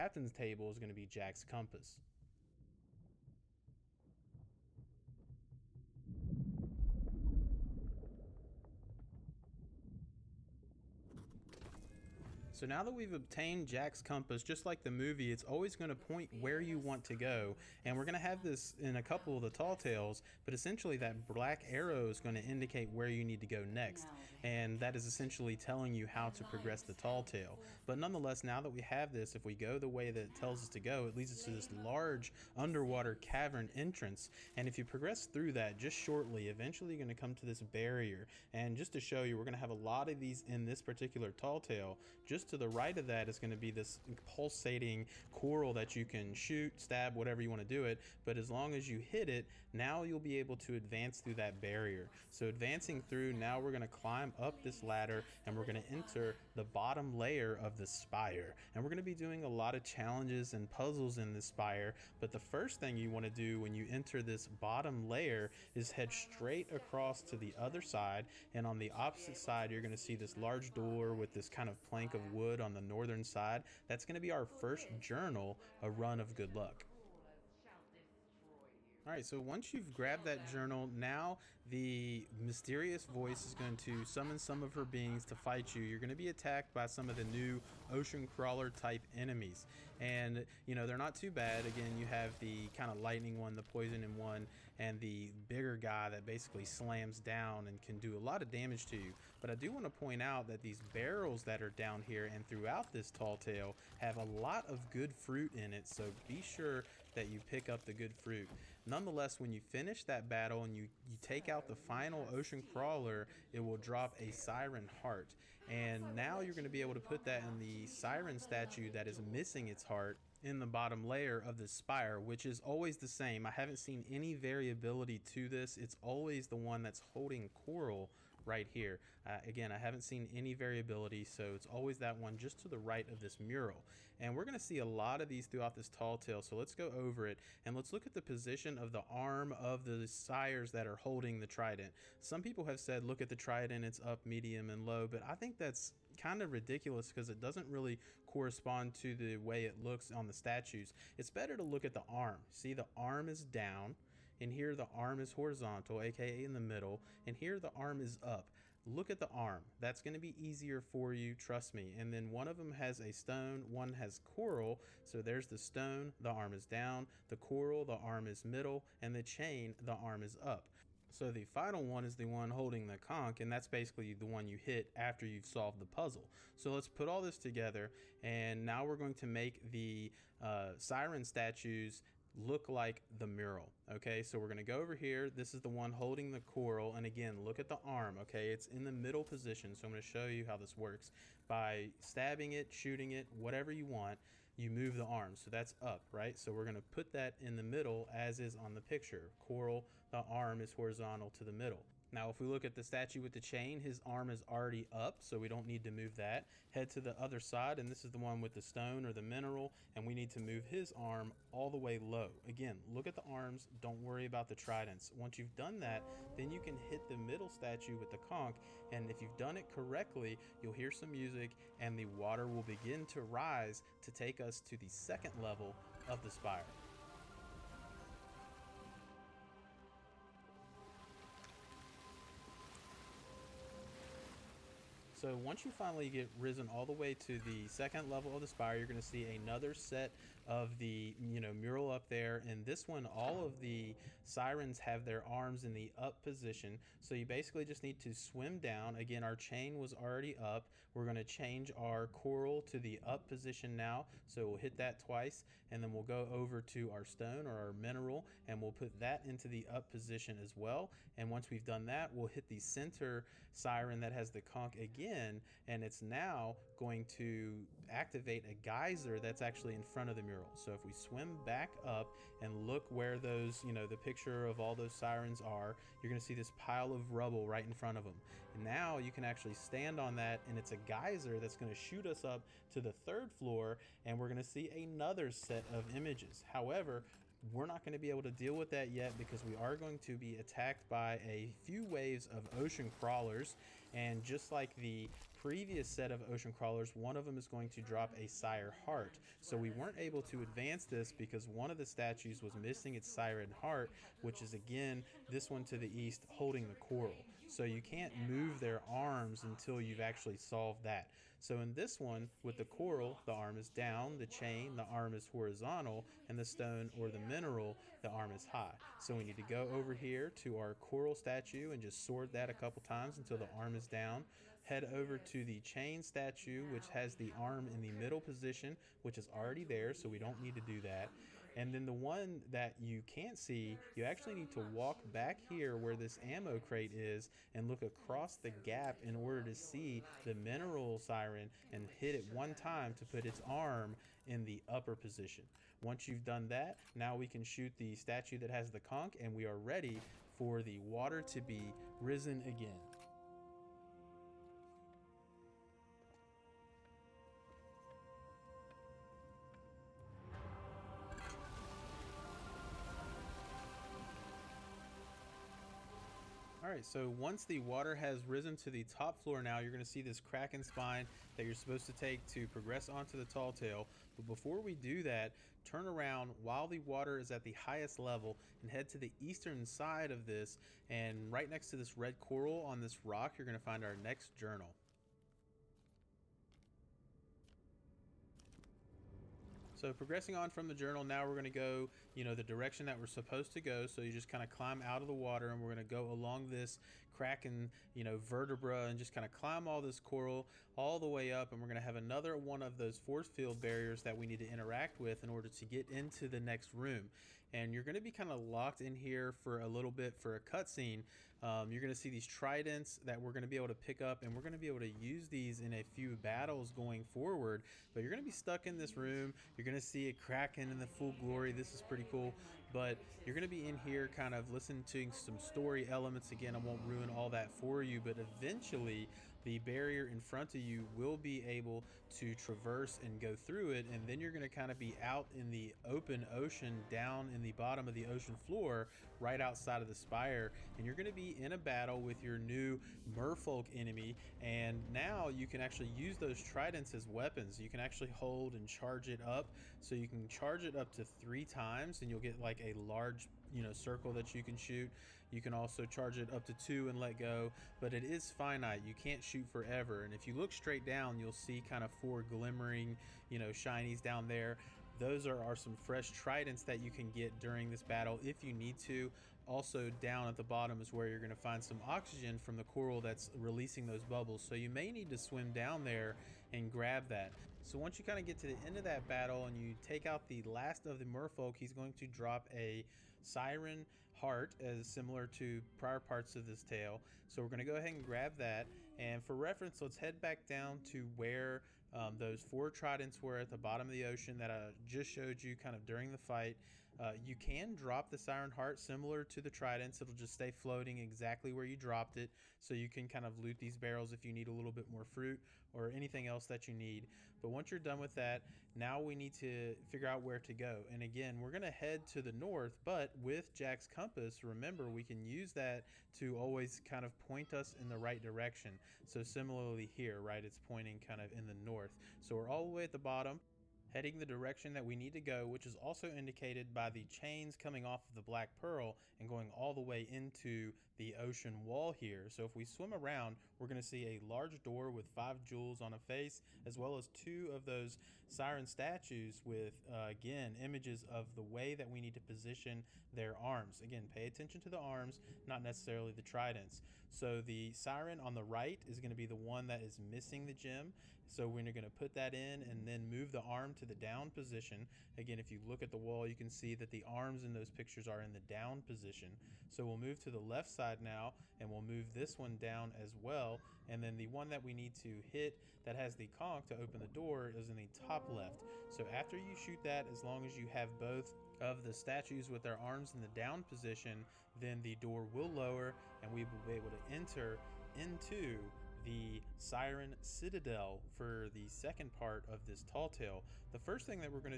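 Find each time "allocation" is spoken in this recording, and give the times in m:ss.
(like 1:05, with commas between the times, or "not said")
not said.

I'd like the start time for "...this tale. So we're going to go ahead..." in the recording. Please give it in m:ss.
8:06.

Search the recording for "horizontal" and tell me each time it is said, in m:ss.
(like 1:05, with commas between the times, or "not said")
2:35, 3:20, 5:15.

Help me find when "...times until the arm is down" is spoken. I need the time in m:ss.
5:22.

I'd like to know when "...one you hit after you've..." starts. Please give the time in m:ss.
2:54.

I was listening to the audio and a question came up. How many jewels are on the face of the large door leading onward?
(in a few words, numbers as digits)
5.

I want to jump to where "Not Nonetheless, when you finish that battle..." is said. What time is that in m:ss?
1:48.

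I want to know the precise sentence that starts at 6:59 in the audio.
You're going going to see it cracking in the full glory.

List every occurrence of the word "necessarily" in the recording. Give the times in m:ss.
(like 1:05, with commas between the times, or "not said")
9:05.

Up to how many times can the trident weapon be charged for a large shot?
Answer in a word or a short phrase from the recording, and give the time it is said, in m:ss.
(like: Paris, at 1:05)
3, at 7:31.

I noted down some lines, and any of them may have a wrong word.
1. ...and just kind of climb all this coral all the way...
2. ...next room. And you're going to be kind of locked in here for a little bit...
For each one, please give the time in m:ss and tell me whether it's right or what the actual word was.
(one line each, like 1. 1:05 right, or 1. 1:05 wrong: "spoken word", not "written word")
1. 6:38 right
2. 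6:46 right.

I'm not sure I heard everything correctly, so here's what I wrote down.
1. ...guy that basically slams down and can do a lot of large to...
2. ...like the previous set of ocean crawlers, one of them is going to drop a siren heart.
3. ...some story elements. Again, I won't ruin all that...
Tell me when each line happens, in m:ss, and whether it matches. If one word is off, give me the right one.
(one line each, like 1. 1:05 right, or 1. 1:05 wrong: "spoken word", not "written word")
1. 1:35 wrong: "damage", not "large"
2. 4:54 right
3. 7:05 right.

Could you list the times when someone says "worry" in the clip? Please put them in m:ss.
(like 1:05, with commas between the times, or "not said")
3:34.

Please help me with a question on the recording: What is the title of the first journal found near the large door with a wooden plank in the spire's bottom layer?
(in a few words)
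A Run of Good Luck.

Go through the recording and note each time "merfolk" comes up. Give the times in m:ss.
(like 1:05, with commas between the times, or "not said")
7:22, 8:01.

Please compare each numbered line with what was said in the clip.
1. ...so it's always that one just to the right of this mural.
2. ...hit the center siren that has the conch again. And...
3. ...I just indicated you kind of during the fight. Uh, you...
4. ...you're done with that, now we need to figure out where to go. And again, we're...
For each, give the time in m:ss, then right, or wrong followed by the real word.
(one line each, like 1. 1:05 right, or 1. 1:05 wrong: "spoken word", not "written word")
1. 2:11 right
2. 4:22 right
3. 8:14 wrong: "showed", not "indicated"
4. 8:27 right.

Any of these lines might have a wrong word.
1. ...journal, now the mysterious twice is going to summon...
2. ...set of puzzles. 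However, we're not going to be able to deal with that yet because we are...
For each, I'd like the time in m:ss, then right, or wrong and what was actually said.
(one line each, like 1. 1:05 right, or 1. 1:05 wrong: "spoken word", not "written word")
1. 1:20 wrong: "voice", not "twice"
2. 4:45 wrong: "images", not "puzzles".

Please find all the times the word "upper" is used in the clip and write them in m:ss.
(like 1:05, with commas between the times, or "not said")
5:44.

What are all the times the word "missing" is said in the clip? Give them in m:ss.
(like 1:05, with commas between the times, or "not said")
1:59, 5:02, 9:09.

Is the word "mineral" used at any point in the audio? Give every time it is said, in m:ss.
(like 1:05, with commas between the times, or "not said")
3:29, 4:17, 5:17, 5:40.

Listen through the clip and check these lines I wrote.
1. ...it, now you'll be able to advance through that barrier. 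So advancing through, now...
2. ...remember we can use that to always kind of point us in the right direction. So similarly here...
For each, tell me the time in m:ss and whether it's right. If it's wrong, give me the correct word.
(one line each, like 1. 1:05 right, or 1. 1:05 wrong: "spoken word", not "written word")
1. 0:49 right
2. 8:34 right.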